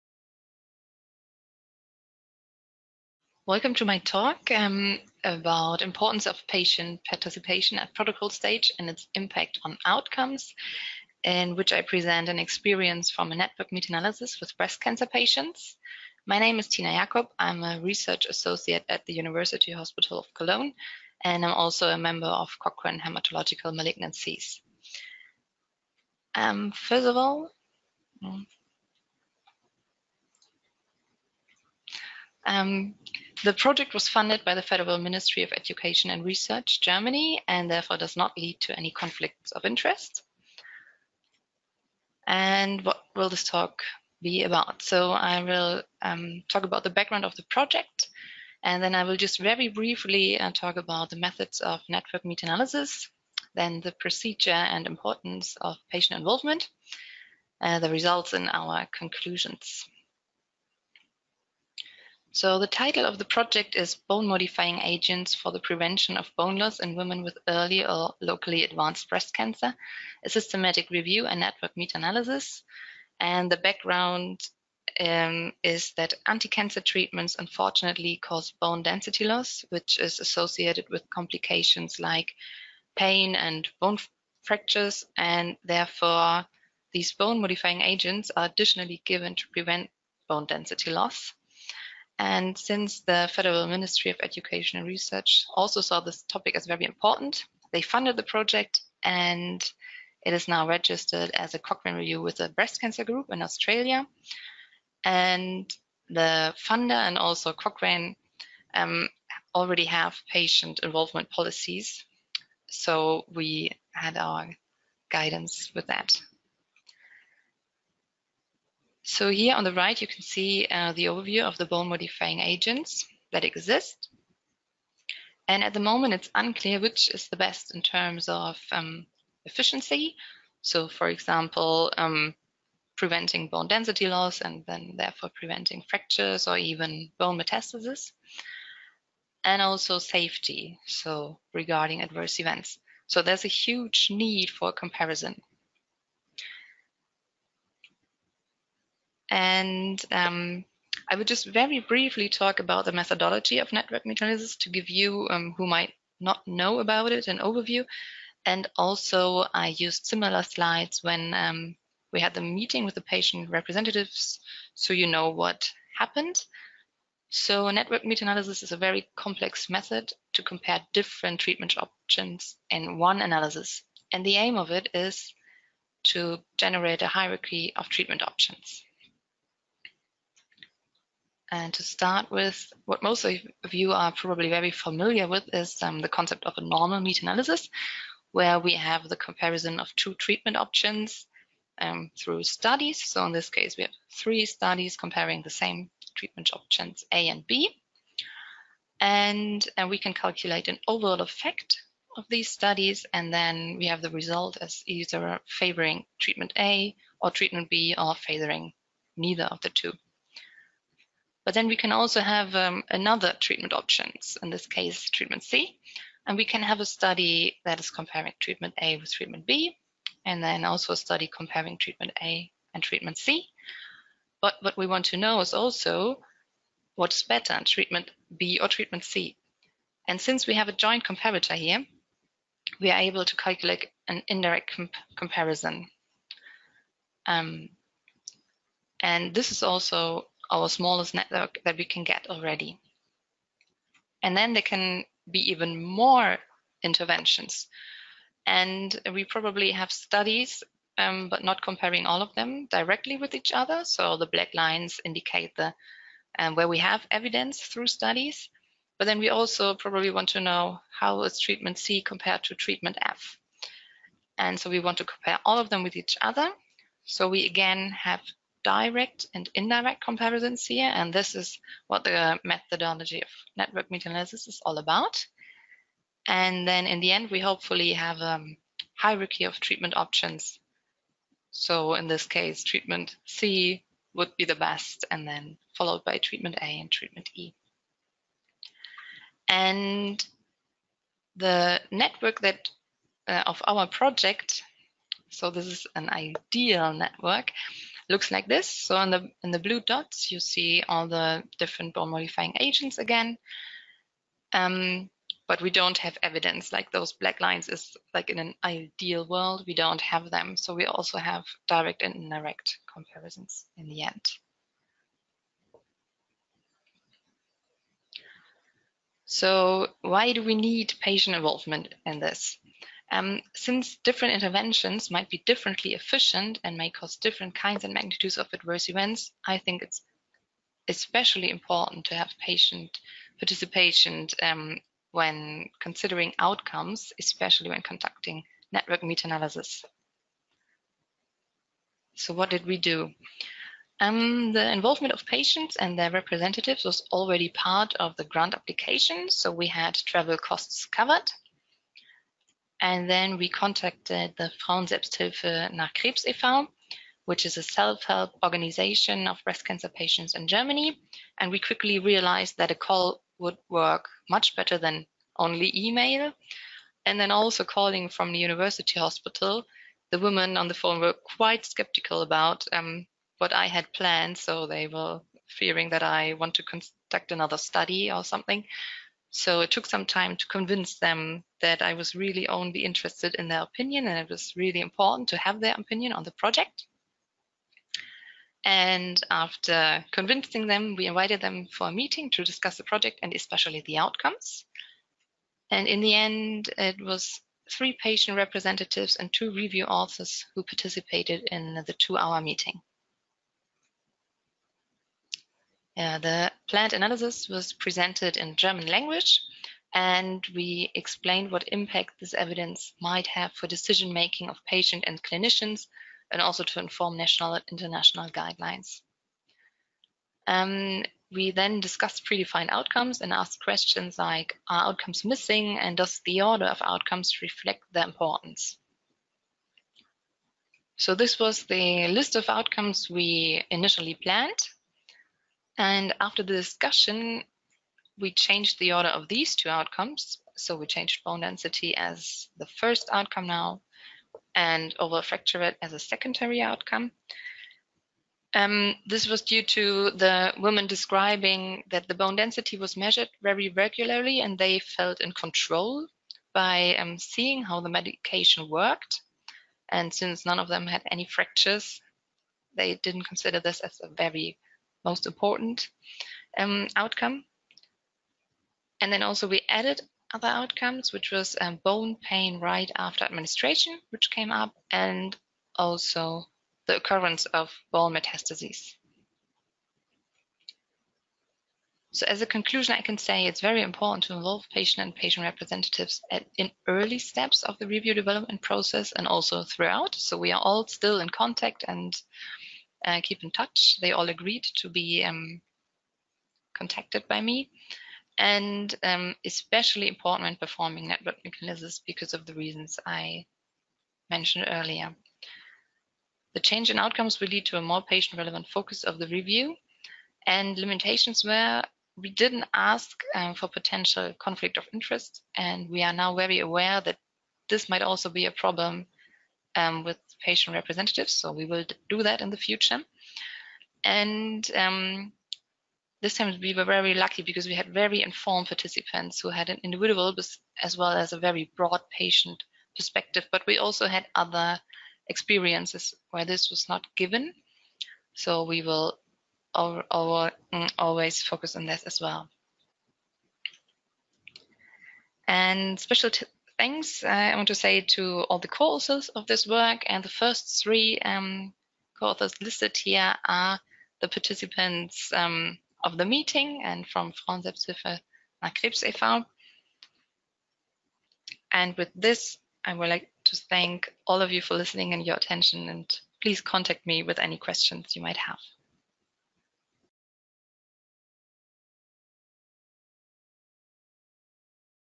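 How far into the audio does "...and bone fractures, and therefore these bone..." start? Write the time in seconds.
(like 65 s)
83 s.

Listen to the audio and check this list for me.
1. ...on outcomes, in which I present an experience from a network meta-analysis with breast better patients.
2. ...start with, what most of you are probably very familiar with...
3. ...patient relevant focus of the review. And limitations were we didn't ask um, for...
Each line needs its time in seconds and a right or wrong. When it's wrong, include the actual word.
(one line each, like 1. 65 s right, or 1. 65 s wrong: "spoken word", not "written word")
1. 9 s wrong: "cancer", not "better"
2. 181 s right
3. 508 s right.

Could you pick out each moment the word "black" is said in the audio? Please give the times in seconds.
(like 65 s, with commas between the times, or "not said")
254 s, 307 s.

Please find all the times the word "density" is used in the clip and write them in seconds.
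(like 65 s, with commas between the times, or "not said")
78 s, 90 s, 133 s, 441 s, 452 s.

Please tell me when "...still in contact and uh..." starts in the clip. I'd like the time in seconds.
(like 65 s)
490 s.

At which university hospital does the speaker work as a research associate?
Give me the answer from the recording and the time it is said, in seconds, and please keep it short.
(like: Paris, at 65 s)
University Hospital of Cologne, at 19 s.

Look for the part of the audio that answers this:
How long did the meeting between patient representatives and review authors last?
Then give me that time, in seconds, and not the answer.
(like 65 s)
401 s.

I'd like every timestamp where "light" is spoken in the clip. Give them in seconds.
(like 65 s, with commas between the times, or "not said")
not said.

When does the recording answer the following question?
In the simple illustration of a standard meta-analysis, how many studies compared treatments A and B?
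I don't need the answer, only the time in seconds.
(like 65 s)
194 s.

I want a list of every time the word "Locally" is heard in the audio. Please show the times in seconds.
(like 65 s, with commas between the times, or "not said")
68 s.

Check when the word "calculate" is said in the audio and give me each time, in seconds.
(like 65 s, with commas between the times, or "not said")
200 s, 233 s.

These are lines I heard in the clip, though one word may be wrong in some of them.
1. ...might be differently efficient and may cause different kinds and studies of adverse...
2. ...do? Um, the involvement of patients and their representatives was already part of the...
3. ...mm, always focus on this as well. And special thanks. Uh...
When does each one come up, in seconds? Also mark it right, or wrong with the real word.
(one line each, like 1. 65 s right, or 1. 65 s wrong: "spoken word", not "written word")
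1. 325 s wrong: "magnitudes", not "studies"
2. 342 s right
3. 539 s right.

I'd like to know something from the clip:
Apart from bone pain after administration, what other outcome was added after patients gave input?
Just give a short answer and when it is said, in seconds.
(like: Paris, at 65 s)
Occurrence of bone metastases, at 476 s.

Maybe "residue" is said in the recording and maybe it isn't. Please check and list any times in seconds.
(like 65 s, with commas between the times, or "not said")
not said.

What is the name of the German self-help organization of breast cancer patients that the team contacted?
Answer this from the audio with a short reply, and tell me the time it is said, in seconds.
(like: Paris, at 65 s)
Frauen Selbsthilfe nach Krebs e.V., at 354 s.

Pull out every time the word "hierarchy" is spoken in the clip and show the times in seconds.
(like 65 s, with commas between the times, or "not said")
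177 s, 278 s.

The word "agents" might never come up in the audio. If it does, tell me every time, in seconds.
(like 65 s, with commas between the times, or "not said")
64 s, 87 s, 122 s, 302 s.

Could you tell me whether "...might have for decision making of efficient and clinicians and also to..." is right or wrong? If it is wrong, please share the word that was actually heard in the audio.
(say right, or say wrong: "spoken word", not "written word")
wrong: "patient", not "efficient".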